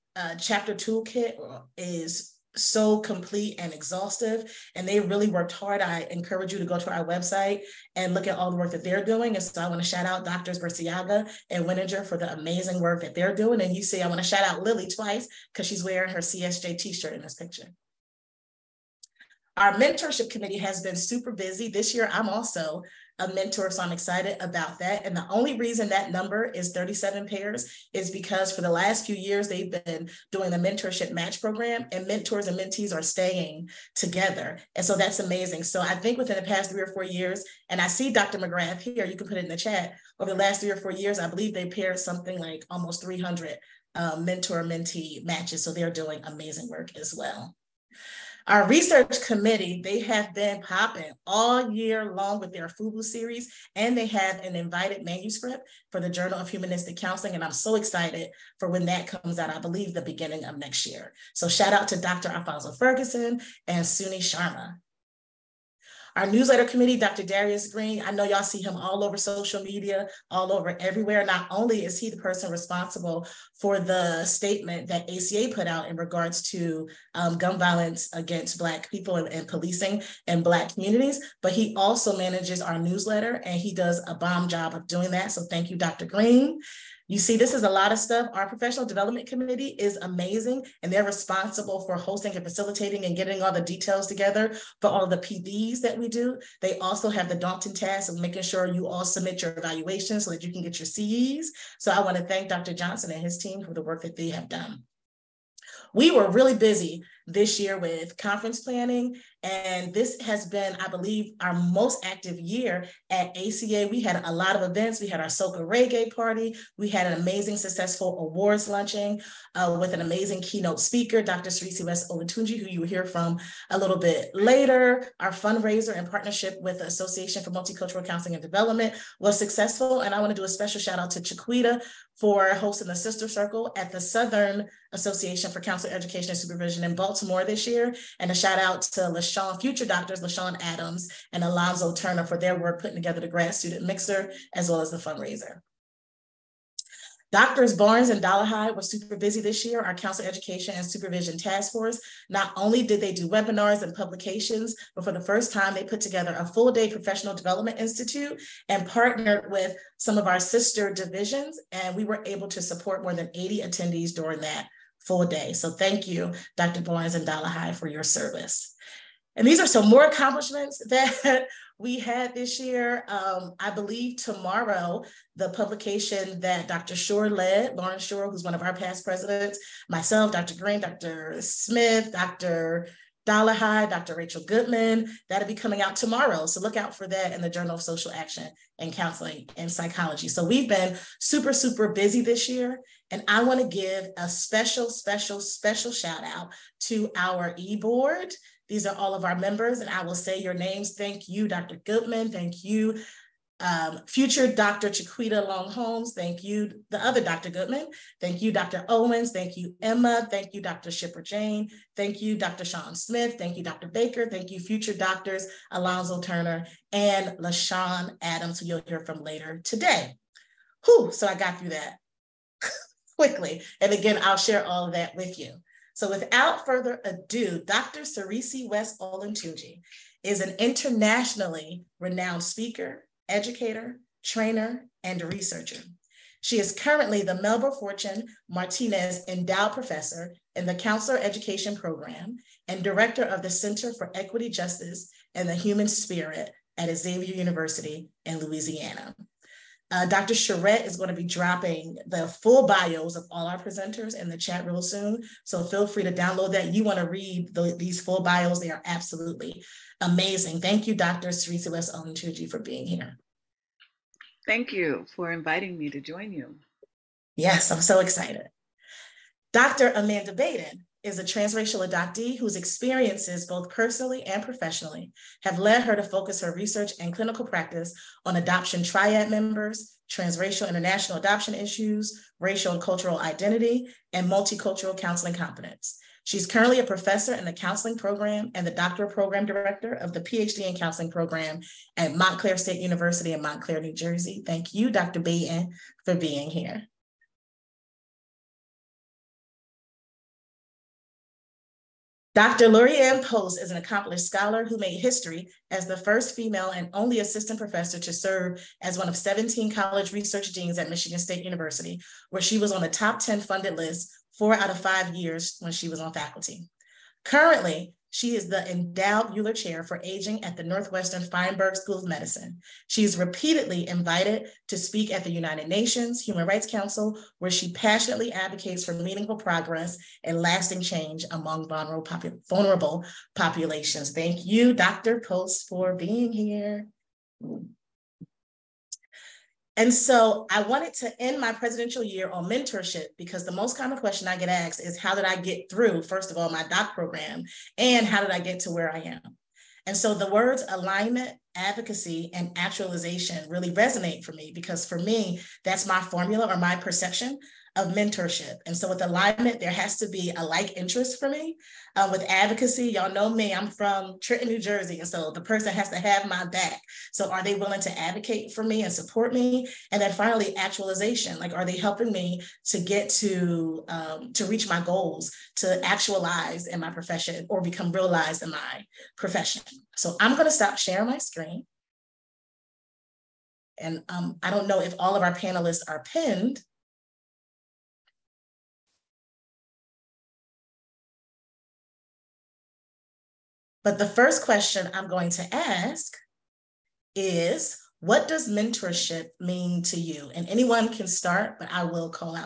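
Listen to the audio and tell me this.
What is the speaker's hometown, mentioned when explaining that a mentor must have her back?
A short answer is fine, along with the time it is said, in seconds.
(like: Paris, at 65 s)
Trenton, New Jersey, at 364 s.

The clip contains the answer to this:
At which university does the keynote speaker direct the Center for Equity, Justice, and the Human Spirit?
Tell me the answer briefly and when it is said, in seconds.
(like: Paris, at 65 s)
Xavier University, at 246 s.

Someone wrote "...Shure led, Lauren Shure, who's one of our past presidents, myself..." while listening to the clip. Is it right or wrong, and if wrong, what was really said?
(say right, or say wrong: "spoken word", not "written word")
right.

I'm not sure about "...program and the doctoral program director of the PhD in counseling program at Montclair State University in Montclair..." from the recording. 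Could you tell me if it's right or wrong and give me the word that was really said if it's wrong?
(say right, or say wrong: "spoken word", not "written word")
right.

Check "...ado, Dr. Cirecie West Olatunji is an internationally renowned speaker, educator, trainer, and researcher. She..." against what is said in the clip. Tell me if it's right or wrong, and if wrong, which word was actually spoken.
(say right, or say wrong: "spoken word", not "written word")
right.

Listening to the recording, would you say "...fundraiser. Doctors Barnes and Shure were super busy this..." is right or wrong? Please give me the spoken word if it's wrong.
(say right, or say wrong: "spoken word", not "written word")
wrong: "Dollarhide", not "Shure".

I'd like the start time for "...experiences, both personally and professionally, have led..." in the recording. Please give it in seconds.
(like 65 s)
272 s.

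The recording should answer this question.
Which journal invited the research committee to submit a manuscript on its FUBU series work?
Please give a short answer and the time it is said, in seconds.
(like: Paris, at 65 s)
Journal of Humanistic Counseling, at 56 s.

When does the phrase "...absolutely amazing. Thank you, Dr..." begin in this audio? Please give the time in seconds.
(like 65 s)
258 s.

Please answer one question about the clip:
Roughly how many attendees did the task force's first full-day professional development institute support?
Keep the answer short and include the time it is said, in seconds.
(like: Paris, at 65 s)
80, at 163 s.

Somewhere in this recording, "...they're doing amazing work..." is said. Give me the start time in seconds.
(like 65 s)
45 s.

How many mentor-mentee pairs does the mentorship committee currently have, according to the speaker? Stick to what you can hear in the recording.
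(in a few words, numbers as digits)
37.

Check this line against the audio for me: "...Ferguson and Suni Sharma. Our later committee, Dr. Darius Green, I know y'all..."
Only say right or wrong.
wrong.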